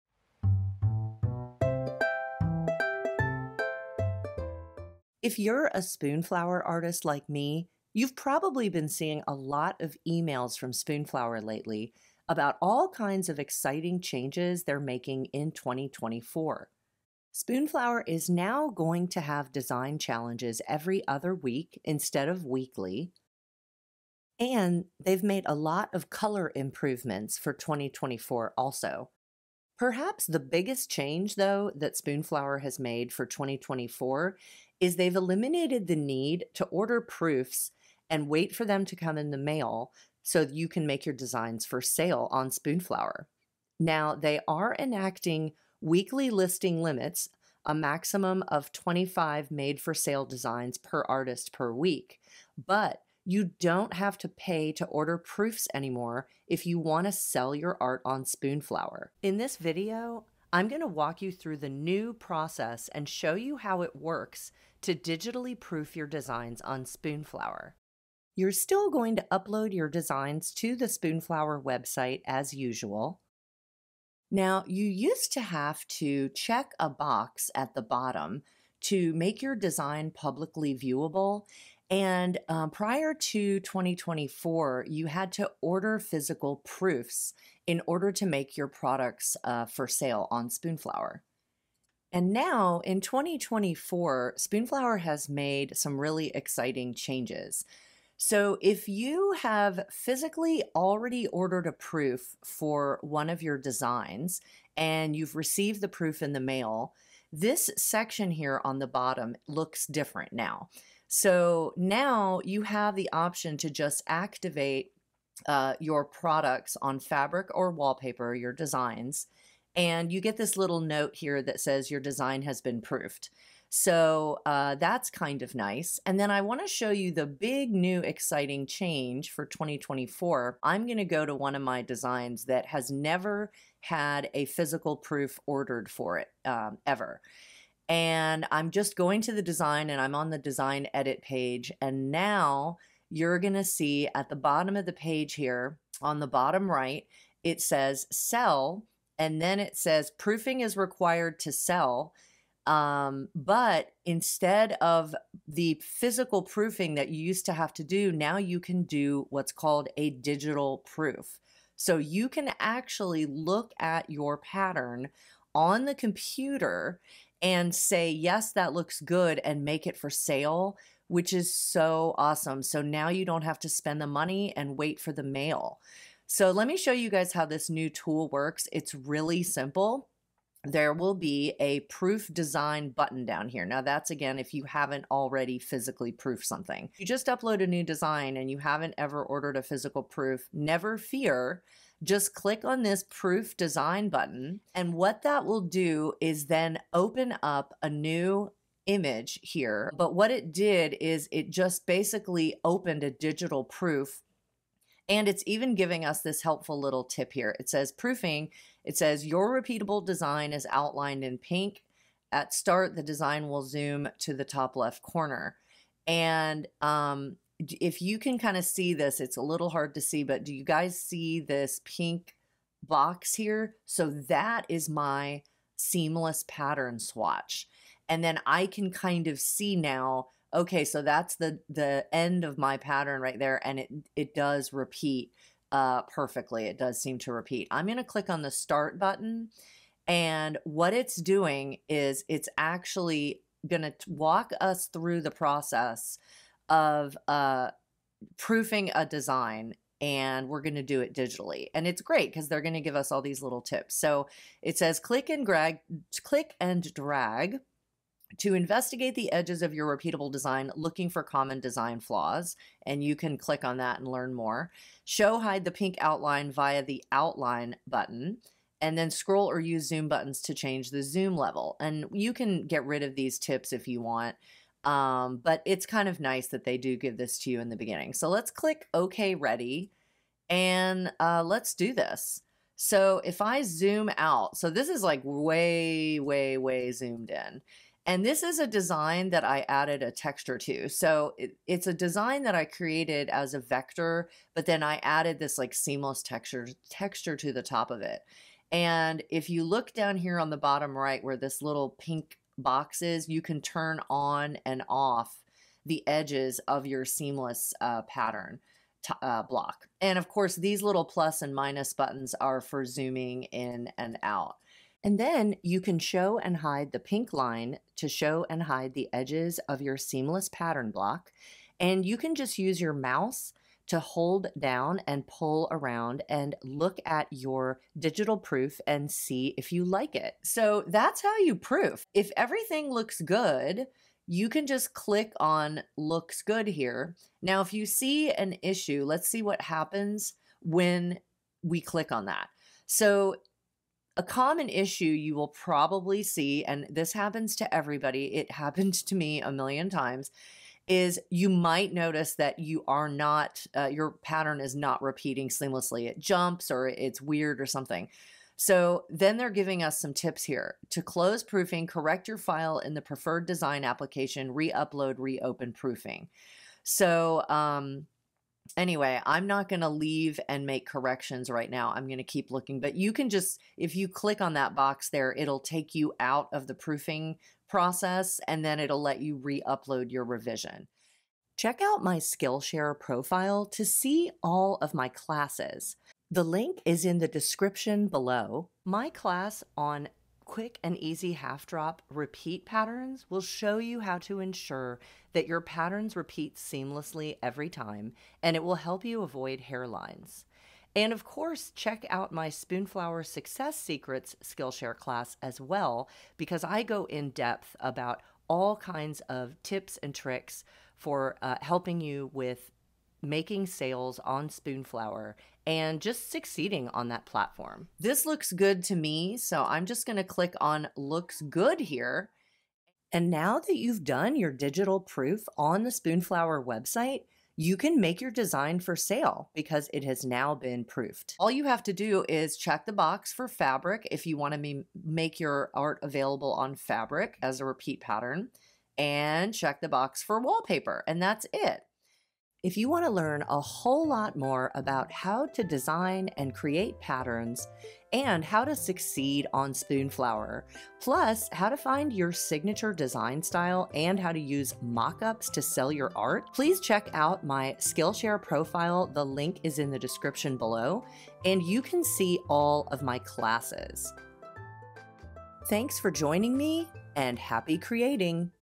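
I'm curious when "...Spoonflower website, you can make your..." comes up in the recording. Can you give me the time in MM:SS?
07:05.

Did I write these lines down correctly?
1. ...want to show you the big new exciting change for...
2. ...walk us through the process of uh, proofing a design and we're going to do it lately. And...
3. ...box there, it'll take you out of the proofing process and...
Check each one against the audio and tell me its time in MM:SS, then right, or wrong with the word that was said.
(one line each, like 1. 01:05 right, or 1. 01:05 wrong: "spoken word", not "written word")
1. 02:06 right
2. 04:04 wrong: "digitally", not "lately"
3. 06:14 right.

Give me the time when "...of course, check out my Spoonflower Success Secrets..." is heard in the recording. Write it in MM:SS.
06:41.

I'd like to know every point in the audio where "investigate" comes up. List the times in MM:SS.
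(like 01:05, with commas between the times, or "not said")
04:18.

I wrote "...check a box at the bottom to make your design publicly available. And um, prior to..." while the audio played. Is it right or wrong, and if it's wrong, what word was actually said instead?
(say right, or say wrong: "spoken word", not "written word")
wrong: "viewable", not "available".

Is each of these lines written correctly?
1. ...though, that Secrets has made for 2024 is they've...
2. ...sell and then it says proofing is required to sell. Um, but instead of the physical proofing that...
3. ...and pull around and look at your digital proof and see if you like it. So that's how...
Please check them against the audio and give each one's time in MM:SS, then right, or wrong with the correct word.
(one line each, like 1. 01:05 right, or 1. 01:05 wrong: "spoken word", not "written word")
1. 00:31 wrong: "Spoonflower", not "Secrets"
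2. 02:28 right
3. 05:25 right.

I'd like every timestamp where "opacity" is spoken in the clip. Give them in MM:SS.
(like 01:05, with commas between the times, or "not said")
not said.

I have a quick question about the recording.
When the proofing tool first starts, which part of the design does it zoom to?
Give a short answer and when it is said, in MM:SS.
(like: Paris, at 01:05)
Top left corner, at 03:34.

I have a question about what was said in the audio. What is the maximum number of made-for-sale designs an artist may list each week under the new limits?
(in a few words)
25.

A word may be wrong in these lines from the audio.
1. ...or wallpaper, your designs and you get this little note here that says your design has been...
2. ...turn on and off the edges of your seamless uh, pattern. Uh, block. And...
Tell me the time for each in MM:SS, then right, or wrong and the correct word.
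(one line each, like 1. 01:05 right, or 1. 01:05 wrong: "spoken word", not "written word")
1. 01:57 right
2. 05:03 right.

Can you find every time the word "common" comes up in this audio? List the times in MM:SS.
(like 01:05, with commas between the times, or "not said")
04:21, 05:44.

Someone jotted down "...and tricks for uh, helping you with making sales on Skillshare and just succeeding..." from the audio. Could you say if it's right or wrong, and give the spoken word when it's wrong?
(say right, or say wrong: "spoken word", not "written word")
wrong: "Spoonflower", not "Skillshare".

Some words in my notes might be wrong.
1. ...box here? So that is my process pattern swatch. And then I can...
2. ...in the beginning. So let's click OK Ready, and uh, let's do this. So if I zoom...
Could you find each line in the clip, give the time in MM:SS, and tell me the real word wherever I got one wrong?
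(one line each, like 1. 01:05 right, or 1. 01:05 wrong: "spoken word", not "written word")
1. 03:42 wrong: "seamless", not "process"
2. 04:37 right.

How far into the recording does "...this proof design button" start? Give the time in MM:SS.
03:12.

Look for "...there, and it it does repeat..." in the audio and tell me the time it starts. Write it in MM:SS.
03:53.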